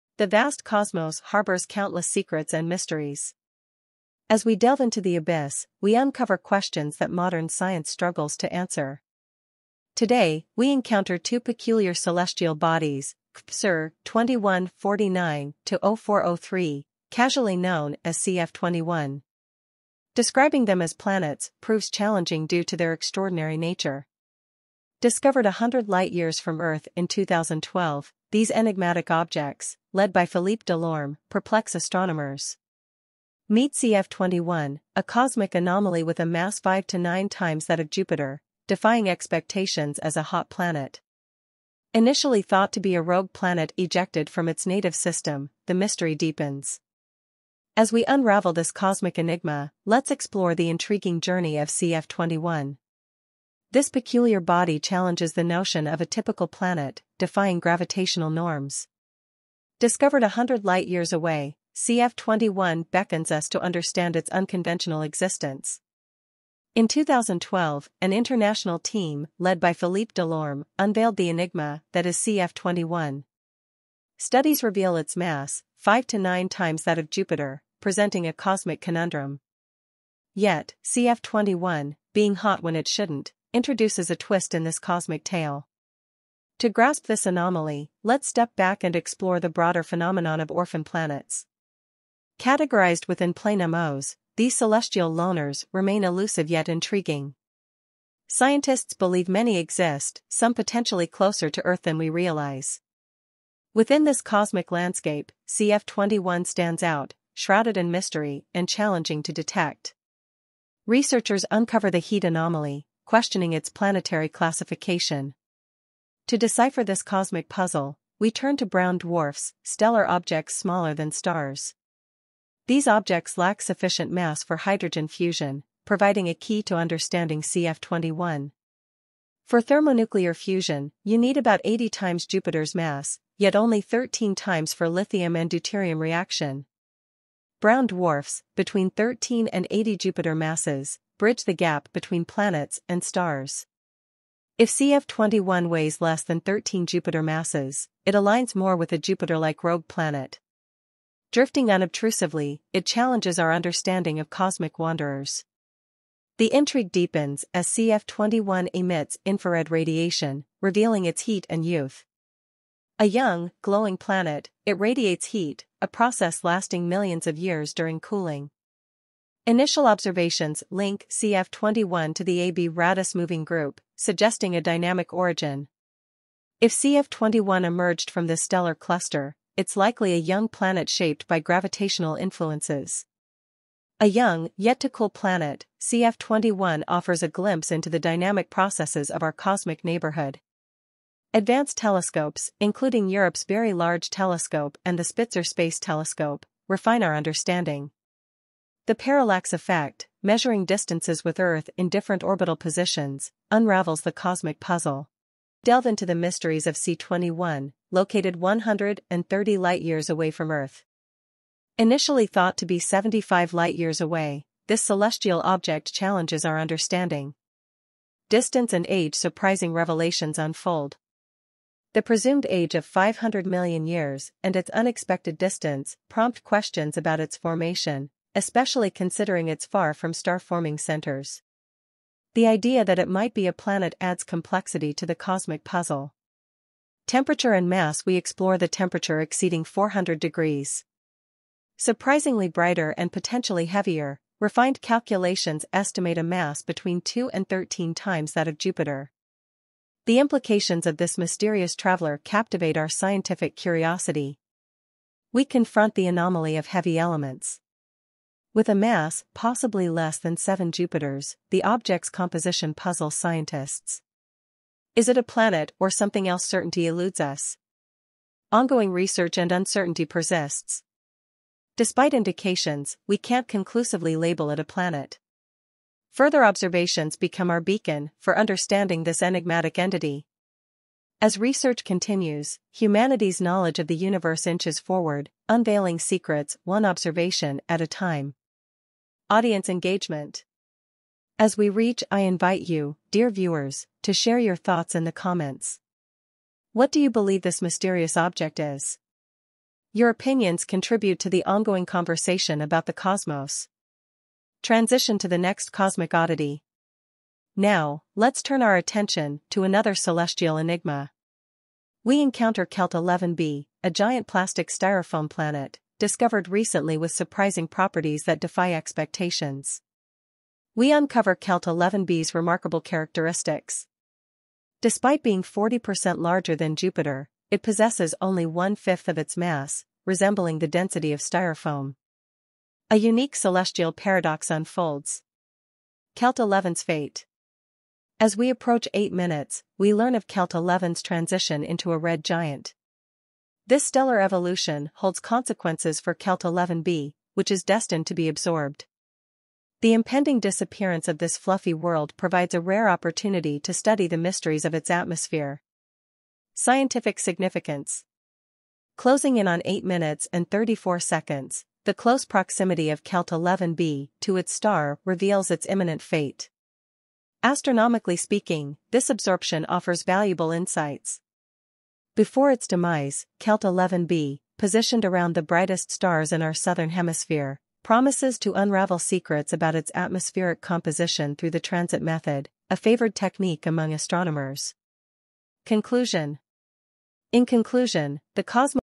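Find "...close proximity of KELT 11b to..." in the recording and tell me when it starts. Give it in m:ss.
6:01.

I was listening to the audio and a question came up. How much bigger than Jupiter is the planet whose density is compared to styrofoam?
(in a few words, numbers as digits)
40%.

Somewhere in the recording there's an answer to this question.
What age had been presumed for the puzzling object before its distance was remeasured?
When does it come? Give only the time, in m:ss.
3:42.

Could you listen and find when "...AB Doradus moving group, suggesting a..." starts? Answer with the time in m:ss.
2:52.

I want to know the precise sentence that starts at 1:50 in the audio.
Researchers uncover the heat anomaly, questioning its planetary classification.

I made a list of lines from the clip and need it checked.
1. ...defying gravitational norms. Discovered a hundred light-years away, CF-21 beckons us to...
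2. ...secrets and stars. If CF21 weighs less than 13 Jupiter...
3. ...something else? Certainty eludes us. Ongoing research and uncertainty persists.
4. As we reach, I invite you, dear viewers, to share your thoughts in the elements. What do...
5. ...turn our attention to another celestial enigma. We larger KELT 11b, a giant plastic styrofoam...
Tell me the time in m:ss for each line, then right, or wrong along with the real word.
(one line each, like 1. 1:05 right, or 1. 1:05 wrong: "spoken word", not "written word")
1. 0:57 right
2. 2:22 wrong: "planets", not "secrets"
3. 4:25 right
4. 4:51 wrong: "comments", not "elements"
5. 5:08 wrong: "encounter", not "larger".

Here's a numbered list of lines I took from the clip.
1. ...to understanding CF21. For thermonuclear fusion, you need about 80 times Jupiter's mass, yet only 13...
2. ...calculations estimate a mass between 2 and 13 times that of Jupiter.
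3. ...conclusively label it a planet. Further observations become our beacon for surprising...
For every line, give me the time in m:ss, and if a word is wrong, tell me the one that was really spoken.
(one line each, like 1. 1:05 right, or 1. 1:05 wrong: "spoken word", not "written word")
1. 2:06 right
2. 4:04 right
3. 4:33 wrong: "understanding", not "surprising".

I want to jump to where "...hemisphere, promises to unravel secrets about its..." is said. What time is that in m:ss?
6:16.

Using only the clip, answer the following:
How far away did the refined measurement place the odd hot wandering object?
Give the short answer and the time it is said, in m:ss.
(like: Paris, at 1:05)
130 light years, at 3:28.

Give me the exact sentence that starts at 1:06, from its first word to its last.
In 2012, an international team, led by Philippe Delorme, unveiled the enigma that is CF-21.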